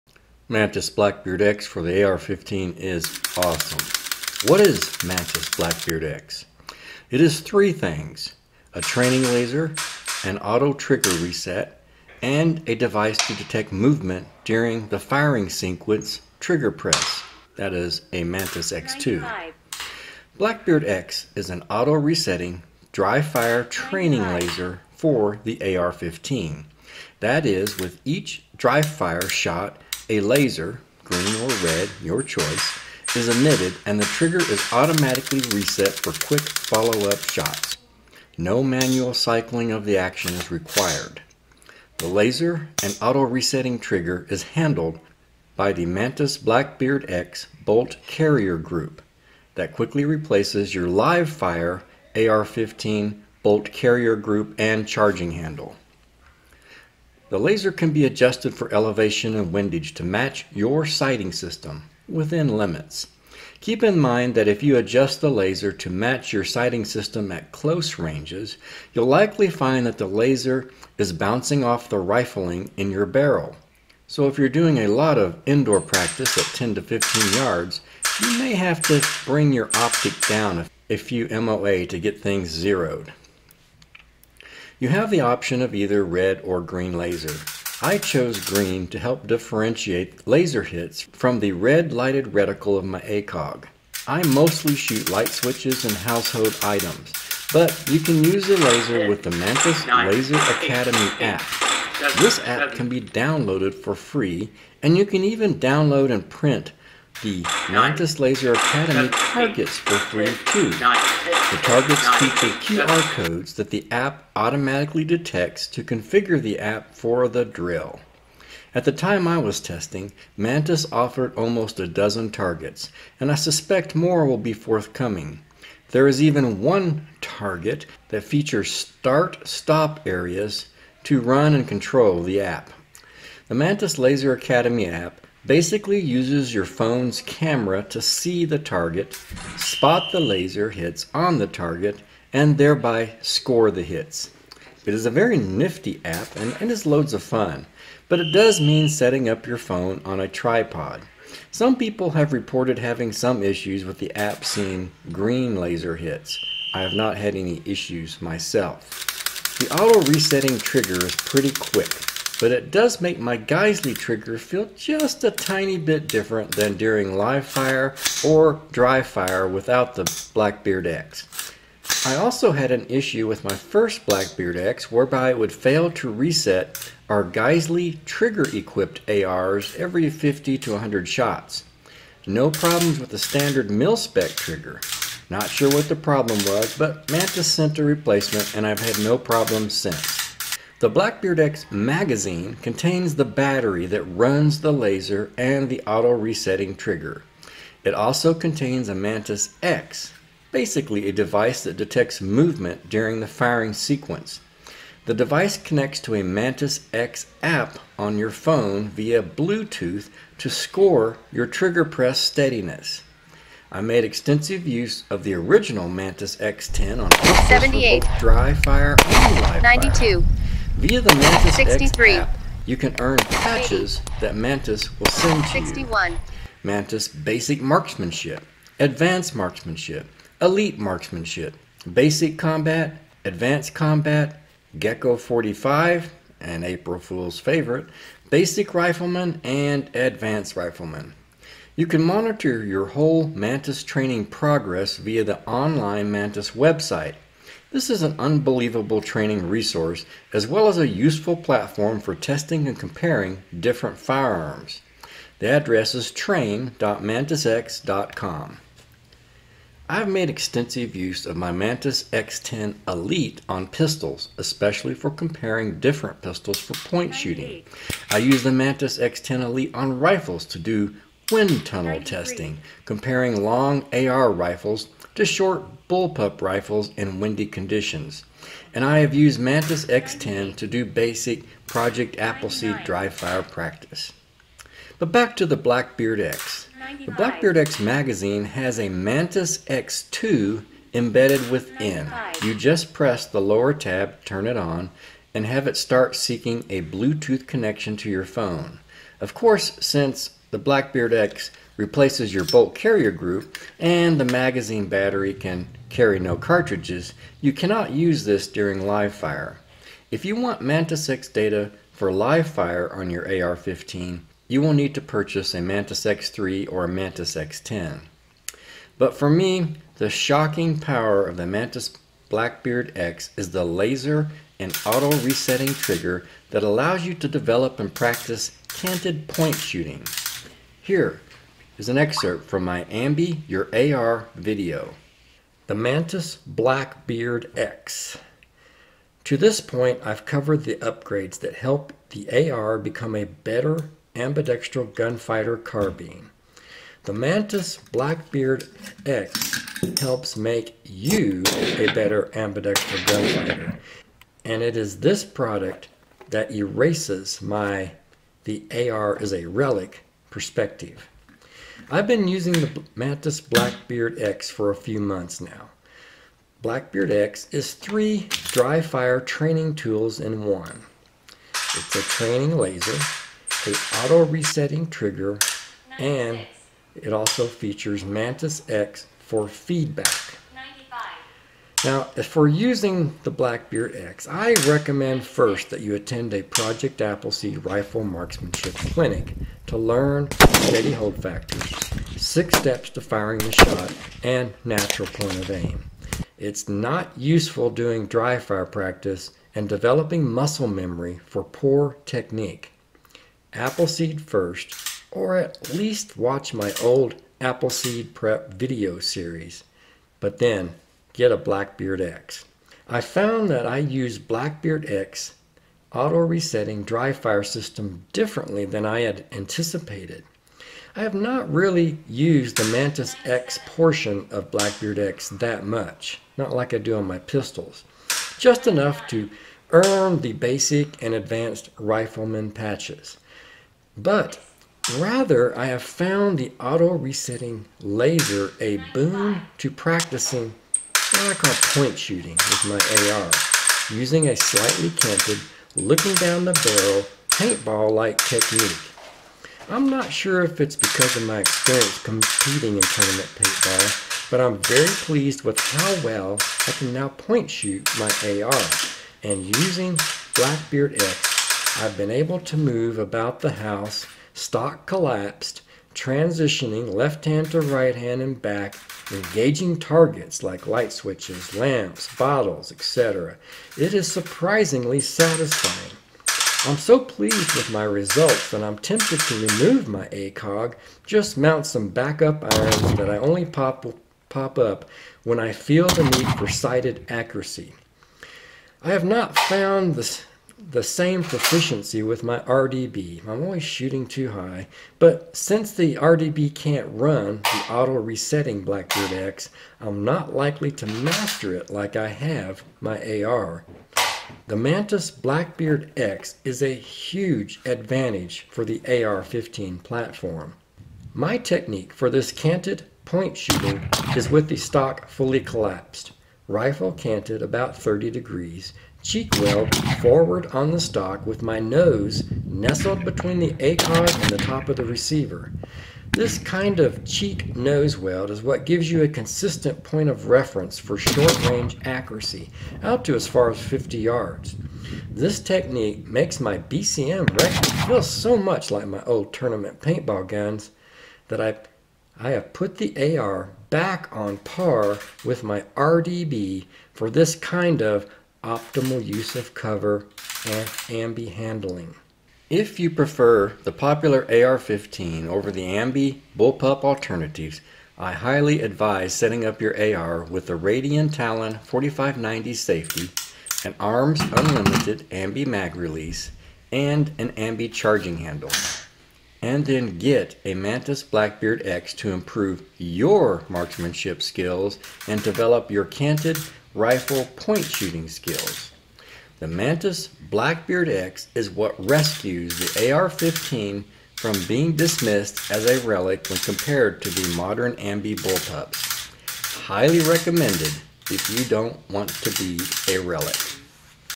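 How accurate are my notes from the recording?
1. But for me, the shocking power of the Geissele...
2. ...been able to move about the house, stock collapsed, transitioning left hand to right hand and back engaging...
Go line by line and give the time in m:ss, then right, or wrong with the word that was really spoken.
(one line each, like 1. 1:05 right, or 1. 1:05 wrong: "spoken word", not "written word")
1. 5:18 wrong: "Mantis", not "Geissele"
2. 7:41 right.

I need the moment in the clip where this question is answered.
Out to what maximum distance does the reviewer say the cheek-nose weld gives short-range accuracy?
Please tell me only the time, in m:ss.
8:53.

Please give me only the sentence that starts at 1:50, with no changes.
The targets feature QR codes that the app automatically detects to configure the app for the drill.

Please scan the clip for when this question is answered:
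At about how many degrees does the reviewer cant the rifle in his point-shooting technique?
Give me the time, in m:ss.
8:37.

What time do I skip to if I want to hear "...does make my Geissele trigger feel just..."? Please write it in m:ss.
2:42.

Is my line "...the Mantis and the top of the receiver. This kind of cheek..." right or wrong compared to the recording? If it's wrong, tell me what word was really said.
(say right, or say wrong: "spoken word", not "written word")
wrong: "ACOG", not "Mantis".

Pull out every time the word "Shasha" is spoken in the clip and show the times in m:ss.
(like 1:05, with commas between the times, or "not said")
not said.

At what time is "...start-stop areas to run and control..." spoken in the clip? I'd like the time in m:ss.
2:08.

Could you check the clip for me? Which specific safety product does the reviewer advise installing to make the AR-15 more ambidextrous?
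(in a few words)
Radian Talon 4590.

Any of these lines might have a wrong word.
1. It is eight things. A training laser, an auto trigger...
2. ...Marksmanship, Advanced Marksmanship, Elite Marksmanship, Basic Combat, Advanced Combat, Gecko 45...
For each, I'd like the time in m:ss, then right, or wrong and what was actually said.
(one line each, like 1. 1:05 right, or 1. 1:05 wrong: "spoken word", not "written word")
1. 0:07 wrong: "three", not "eight"
2. 3:47 right.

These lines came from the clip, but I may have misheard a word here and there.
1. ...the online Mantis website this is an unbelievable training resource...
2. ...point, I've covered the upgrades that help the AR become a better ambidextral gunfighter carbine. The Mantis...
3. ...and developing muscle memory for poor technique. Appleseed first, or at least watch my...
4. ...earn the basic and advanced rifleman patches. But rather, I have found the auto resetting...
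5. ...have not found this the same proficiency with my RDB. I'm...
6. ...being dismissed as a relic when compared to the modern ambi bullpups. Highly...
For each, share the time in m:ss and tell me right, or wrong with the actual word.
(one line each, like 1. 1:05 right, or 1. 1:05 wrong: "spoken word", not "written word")
1. 4:05 right
2. 5:39 right
3. 6:39 right
4. 7:09 right
5. 8:08 right
6. 9:44 right.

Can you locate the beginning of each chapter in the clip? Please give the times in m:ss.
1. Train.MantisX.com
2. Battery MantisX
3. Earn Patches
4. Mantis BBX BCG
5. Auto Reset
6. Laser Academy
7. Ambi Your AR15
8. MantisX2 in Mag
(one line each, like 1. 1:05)
1. 4:01
2. 3:10
3. 3:42
4. 0:41
5. 2:39
6. 1:37
7. 5:35
8. 4:46.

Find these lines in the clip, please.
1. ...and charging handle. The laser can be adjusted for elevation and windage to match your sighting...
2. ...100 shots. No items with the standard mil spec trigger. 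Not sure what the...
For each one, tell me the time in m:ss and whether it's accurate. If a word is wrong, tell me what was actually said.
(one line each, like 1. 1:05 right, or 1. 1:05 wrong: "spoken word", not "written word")
1. 0:54 right
2. 3:00 wrong: "problems", not "items".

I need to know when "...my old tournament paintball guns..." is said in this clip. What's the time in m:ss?
8:58.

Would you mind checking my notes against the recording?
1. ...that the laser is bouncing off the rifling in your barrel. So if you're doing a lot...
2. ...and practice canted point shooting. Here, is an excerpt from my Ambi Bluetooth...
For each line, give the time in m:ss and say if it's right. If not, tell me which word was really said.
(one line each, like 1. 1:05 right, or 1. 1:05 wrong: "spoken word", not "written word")
1. 1:09 right
2. 5:27 wrong: "Your", not "Bluetooth".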